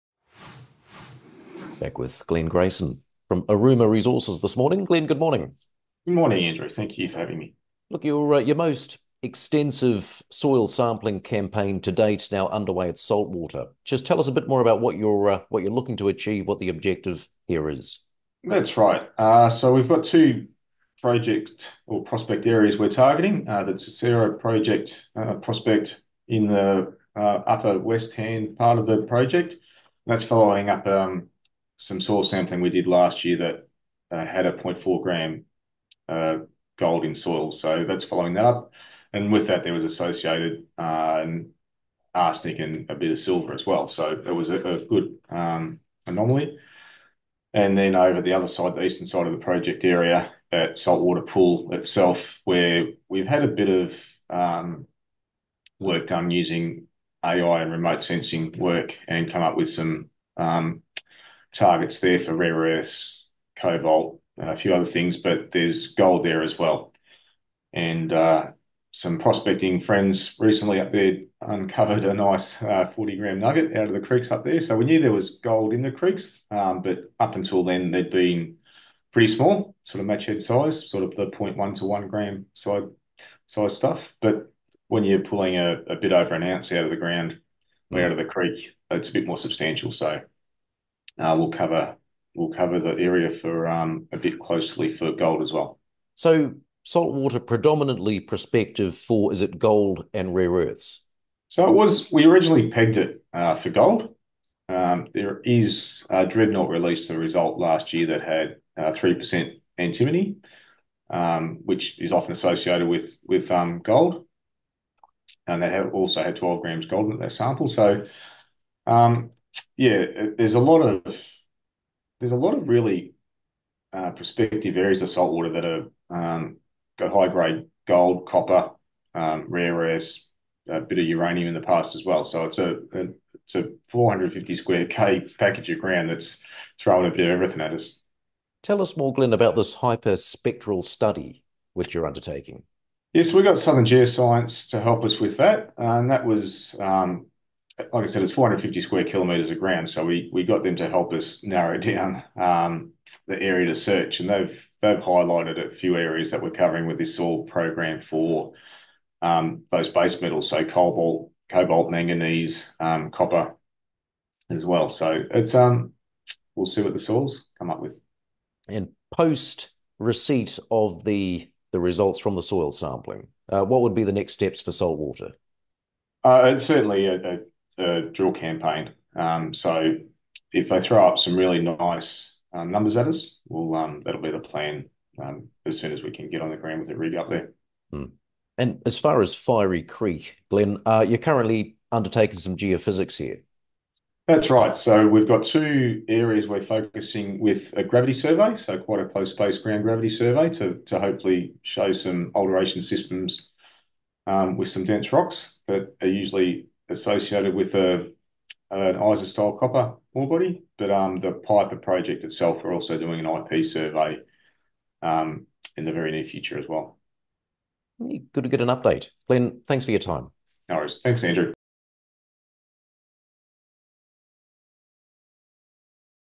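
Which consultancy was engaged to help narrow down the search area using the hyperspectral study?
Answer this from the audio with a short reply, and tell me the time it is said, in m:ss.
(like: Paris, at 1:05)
Southern Geoscience, at 2:23.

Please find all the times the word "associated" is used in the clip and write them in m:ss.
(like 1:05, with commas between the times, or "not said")
0:39, 1:52, 3:26.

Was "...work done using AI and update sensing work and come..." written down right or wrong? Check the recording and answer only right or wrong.
wrong.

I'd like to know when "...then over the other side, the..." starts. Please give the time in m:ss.
0:47.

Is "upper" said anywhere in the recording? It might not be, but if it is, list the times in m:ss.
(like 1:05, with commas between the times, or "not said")
0:27.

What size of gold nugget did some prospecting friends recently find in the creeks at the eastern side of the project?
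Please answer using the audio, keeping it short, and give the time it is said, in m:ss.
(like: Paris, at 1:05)
40 grams, at 1:12.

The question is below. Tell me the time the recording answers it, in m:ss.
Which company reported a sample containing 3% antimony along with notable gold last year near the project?
1:46.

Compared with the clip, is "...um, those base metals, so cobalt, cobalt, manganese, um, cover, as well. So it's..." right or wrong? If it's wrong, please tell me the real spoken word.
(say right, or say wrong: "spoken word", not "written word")
wrong: "copper", not "cover".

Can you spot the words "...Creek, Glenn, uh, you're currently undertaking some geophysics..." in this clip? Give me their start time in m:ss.
3:09.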